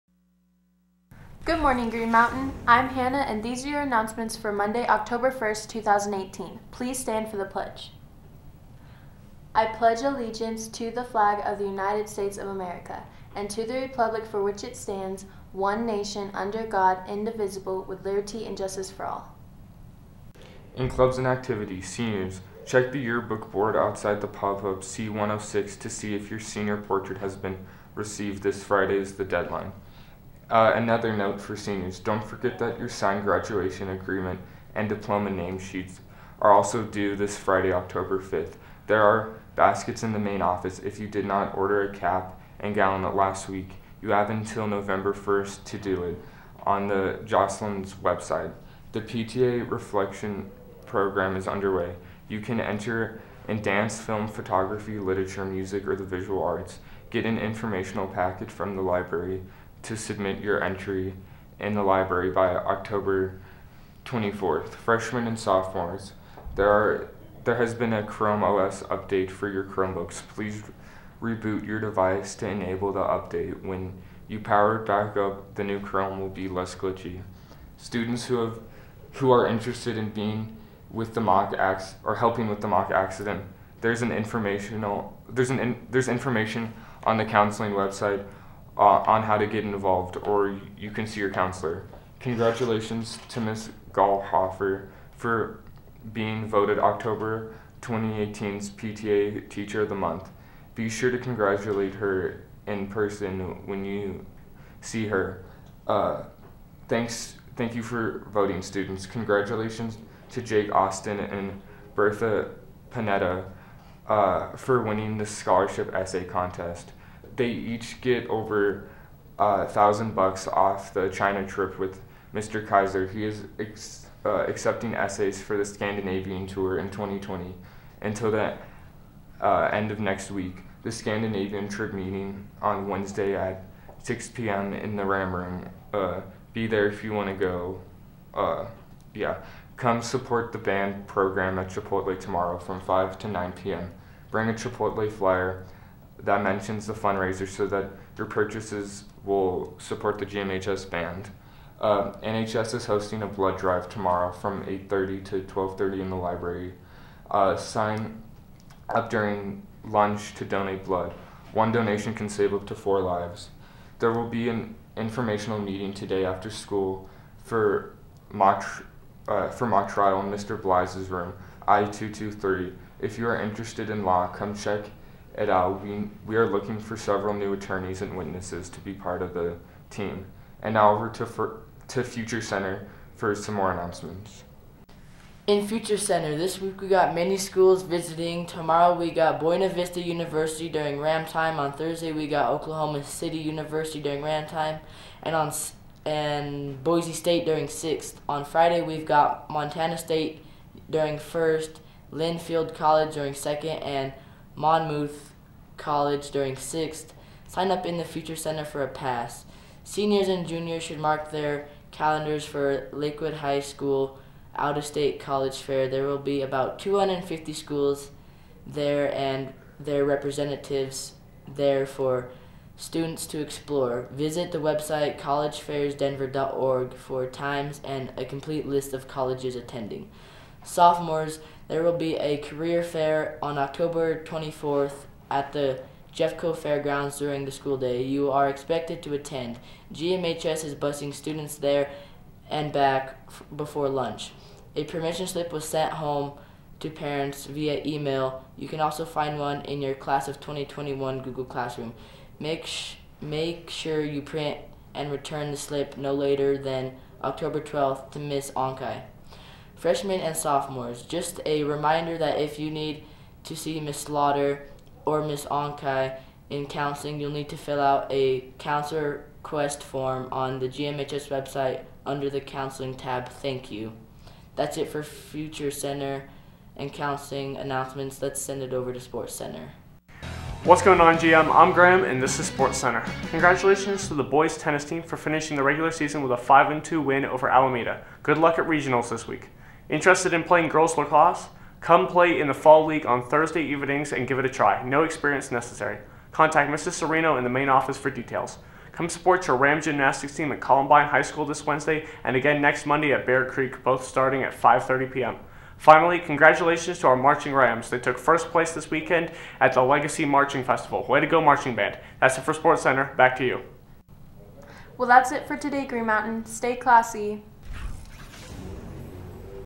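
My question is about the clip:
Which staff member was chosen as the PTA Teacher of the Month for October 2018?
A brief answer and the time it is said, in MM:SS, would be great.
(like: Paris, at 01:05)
Ms. Gallhofer, at 01:33.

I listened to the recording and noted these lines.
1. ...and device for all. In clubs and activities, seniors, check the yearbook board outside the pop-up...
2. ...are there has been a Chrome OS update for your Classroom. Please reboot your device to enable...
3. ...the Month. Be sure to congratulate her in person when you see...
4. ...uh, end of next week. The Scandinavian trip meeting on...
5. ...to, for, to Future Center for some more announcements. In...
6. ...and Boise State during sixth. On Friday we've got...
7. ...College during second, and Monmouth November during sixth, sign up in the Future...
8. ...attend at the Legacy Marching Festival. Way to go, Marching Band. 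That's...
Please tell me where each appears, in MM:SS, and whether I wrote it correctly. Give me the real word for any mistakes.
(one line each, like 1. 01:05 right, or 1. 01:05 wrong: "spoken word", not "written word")
1. 00:18 wrong: "justice", not "device"
2. 01:06 wrong: "Chromebooks", not "Classroom"
3. 01:39 right
4. 02:09 right
5. 03:01 right
6. 03:16 right
7. 03:22 wrong: "College", not "November"
8. 05:08 wrong: "weekend", not "attend".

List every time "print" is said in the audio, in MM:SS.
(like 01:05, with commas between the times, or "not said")
04:14.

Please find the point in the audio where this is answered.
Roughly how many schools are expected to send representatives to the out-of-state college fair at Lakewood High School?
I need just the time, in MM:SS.
03:36.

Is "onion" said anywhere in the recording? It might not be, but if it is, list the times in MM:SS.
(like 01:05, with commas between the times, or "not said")
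not said.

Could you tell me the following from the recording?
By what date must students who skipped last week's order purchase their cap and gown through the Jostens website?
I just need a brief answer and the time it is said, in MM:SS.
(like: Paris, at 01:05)
November 1st, at 00:44.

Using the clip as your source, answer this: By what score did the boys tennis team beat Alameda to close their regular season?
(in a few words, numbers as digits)
5-2.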